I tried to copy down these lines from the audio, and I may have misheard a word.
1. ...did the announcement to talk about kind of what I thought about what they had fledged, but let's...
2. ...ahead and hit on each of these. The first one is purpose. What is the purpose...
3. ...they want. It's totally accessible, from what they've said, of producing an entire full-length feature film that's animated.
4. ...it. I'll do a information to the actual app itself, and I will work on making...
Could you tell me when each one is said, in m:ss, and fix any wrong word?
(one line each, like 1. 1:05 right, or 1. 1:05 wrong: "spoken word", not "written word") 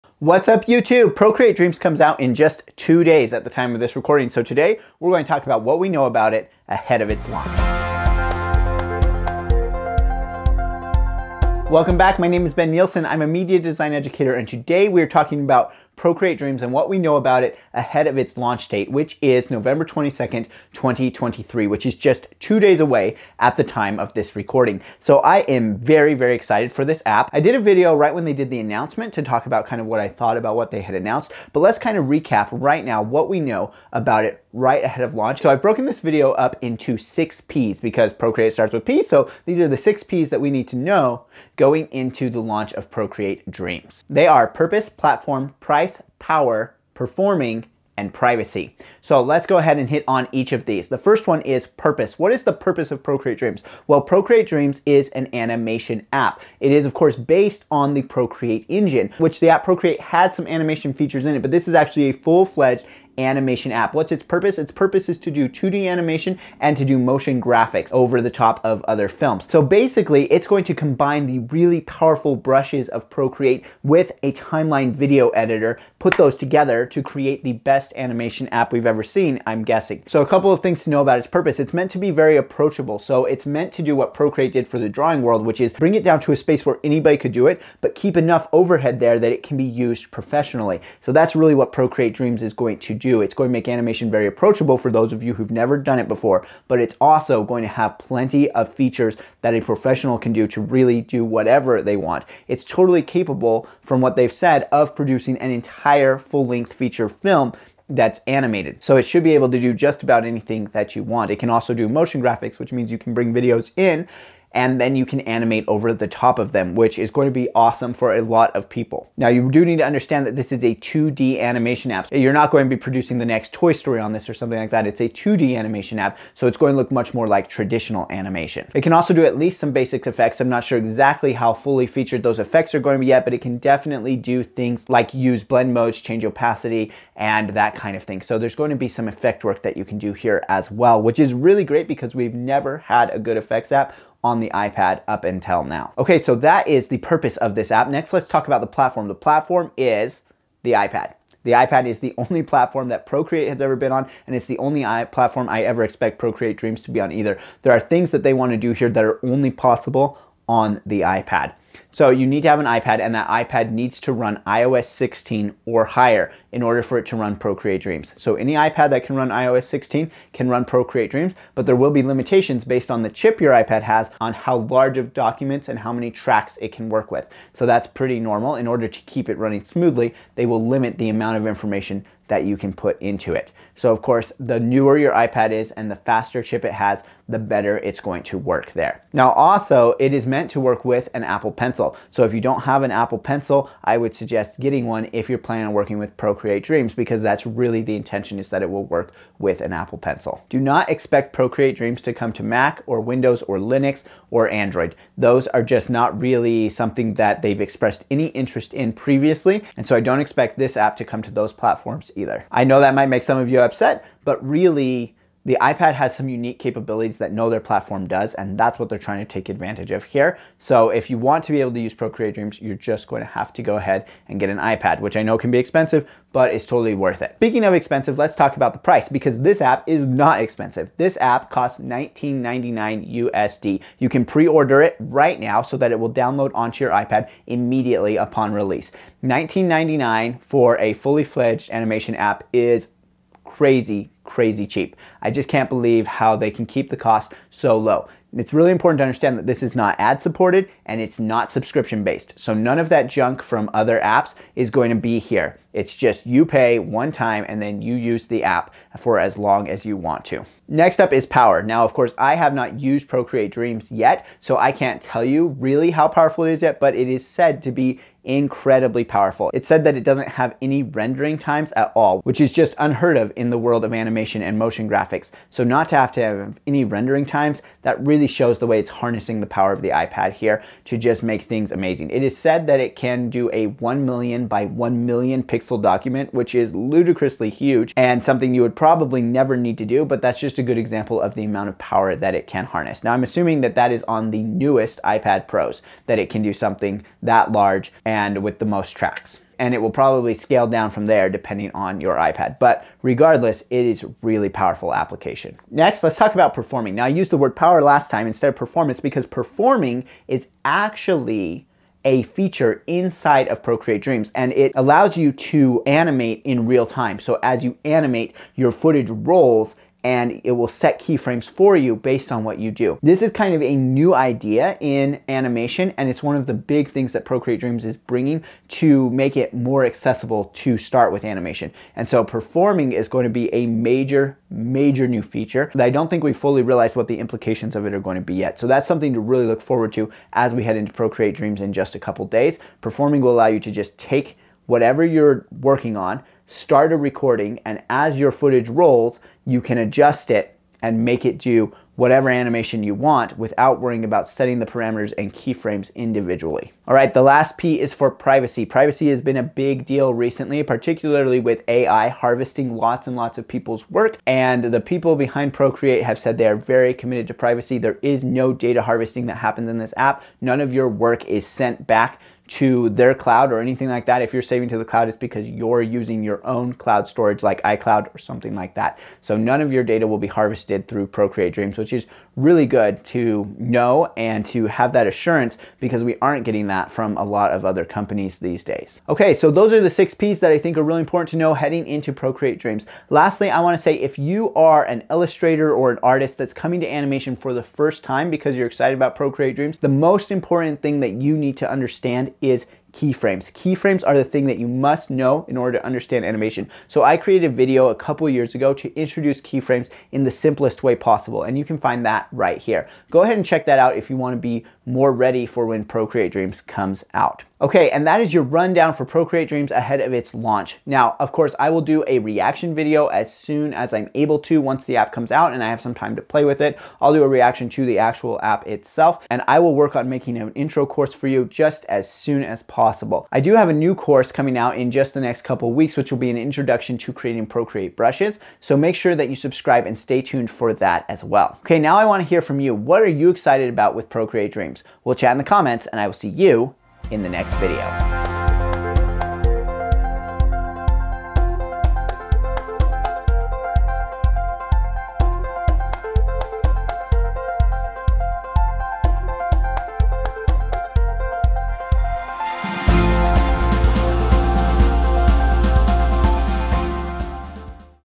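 1. 0:28 wrong: "announced", not "fledged"
2. 0:49 right
3. 1:41 wrong: "capable", not "accessible"
4. 7:06 wrong: "reaction", not "information".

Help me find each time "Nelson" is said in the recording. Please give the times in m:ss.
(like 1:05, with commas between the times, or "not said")
not said.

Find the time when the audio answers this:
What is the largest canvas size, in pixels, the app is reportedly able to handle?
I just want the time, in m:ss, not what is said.
4:43.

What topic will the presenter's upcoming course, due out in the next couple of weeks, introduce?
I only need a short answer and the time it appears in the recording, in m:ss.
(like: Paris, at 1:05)
Creating Procreate brushes, at 7:17.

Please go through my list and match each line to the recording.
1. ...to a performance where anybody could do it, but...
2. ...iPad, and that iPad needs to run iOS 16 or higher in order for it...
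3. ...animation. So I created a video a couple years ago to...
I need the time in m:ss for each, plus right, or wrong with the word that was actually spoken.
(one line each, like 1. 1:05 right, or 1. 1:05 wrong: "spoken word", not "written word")
1. 1:26 wrong: "space", not "performance"
2. 2:42 right
3. 6:46 right.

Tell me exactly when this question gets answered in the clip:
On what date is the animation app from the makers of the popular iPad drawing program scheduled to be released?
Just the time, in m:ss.
0:19.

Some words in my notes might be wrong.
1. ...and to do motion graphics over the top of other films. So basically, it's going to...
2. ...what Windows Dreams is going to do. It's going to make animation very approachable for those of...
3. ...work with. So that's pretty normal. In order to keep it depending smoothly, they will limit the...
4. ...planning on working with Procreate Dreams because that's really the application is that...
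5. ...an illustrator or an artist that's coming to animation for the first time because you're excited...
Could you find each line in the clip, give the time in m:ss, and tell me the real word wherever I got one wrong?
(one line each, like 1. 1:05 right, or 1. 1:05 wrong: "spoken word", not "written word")
1. 1:06 right
2. 1:31 wrong: "Procreate", not "Windows"
3. 2:56 wrong: "running", not "depending"
4. 3:15 wrong: "intention", not "application"
5. 6:34 right.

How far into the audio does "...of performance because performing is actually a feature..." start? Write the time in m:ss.
5:08.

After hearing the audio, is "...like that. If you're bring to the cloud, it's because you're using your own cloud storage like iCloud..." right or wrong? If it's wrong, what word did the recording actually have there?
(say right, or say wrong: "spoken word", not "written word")
wrong: "saving", not "bring".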